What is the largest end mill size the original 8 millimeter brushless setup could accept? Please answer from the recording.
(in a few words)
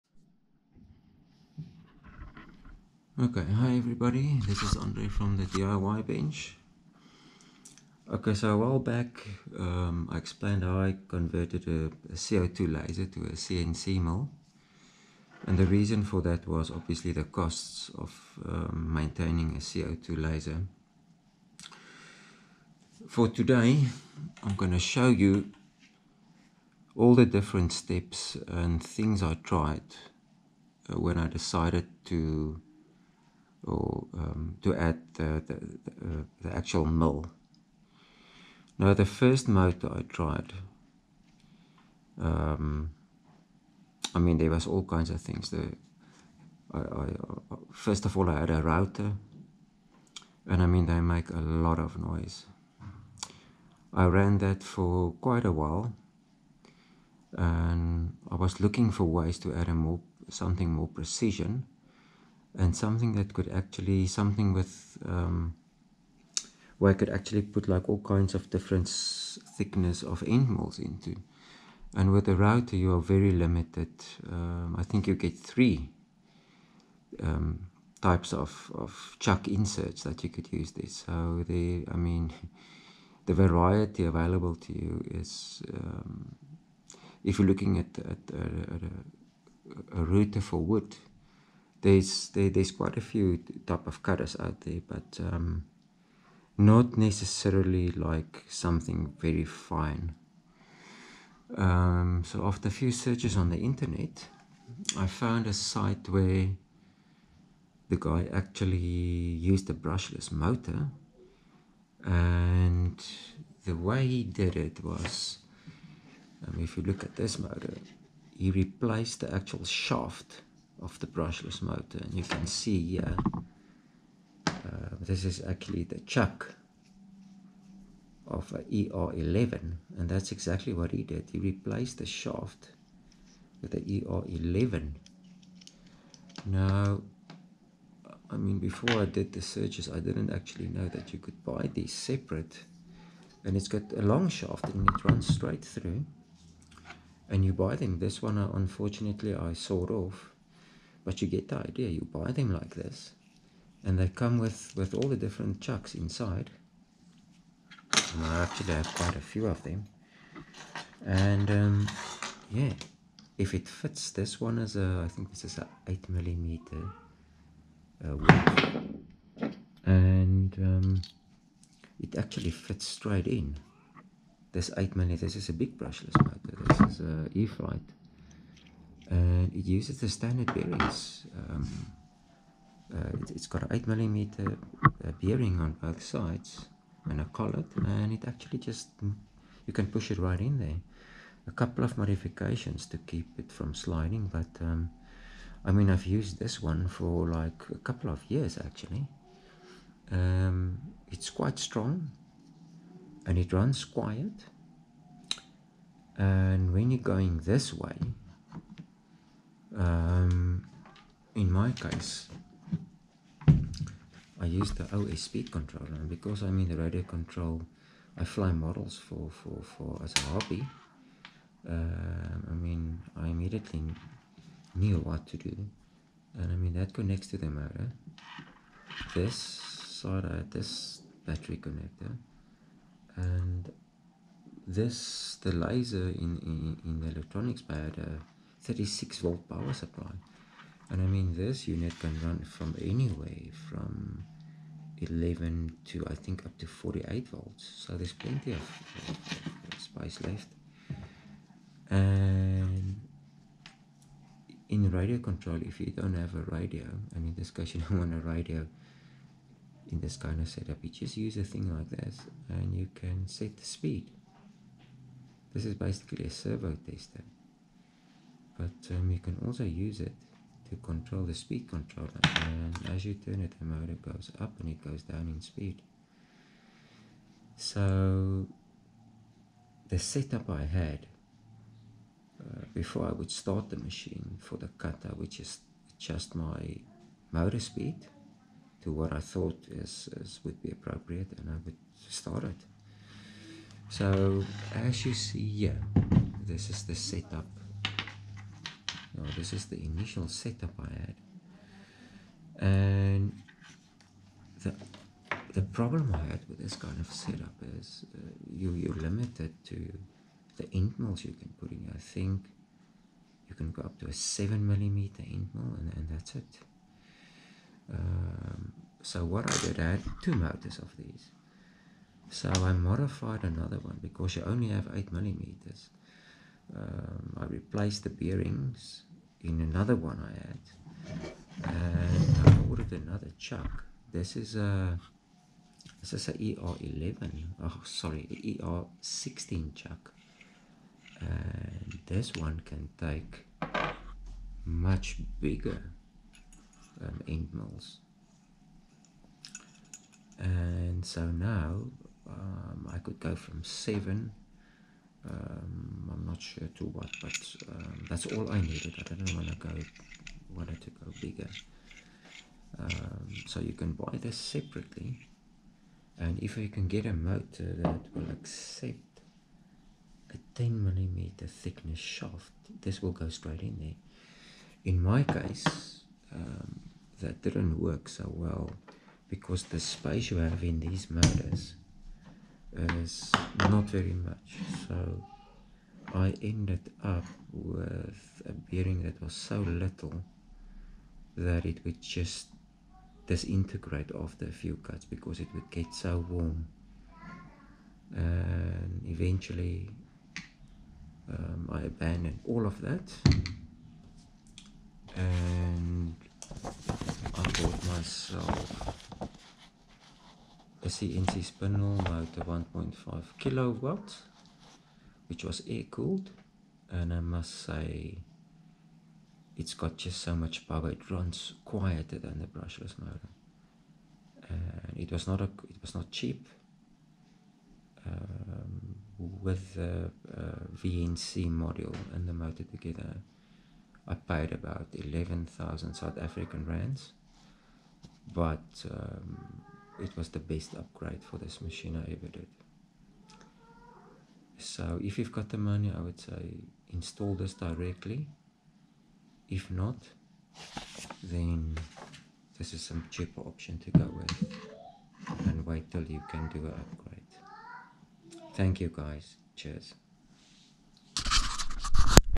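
7 millimeters.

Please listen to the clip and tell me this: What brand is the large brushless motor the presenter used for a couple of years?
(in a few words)
E-flite.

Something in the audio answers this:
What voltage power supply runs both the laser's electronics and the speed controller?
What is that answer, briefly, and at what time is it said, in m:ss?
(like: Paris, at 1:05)
36 volts, at 3:58.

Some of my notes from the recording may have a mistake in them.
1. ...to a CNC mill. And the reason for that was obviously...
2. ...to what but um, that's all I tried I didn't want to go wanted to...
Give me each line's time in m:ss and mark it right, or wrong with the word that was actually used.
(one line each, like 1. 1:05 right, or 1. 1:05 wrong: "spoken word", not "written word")
1. 0:13 right
2. 5:56 wrong: "needed", not "tried".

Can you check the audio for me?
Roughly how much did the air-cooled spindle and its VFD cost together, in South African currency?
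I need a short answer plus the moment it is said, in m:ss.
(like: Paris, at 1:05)
11,000 rands, at 7:14.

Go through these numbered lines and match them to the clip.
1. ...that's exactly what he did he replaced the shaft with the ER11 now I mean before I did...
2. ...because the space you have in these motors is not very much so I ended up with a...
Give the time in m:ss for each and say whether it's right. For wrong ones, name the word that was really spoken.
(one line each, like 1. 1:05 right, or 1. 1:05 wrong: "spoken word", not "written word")
1. 2:10 right
2. 6:19 right.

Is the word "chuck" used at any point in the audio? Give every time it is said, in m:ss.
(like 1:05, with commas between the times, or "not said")
1:19, 2:06, 2:35, 5:33, 5:39.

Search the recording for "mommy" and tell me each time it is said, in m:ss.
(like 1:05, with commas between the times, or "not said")
not said.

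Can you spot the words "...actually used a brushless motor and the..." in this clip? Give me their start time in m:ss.
1:48.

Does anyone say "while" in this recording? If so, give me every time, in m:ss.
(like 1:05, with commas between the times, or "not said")
0:08, 0:55.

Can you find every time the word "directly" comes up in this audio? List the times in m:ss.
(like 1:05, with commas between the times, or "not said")
7:27.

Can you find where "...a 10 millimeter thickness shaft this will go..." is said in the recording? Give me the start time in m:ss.
6:10.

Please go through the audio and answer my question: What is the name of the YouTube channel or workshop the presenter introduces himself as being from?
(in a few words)
The DIY Bench.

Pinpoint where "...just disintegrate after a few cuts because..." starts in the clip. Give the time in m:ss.
6:32.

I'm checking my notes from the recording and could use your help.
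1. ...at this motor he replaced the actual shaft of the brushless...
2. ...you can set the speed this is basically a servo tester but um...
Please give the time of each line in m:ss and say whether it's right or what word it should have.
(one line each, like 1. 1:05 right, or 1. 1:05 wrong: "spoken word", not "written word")
1. 1:57 right
2. 4:22 right.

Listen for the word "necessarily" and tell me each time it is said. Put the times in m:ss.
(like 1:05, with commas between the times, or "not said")
1:36.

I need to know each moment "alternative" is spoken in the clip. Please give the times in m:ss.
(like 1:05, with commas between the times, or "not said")
not said.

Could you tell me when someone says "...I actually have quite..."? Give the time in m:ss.
2:38.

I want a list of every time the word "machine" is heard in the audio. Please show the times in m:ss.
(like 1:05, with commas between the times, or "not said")
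4:43, 7:21.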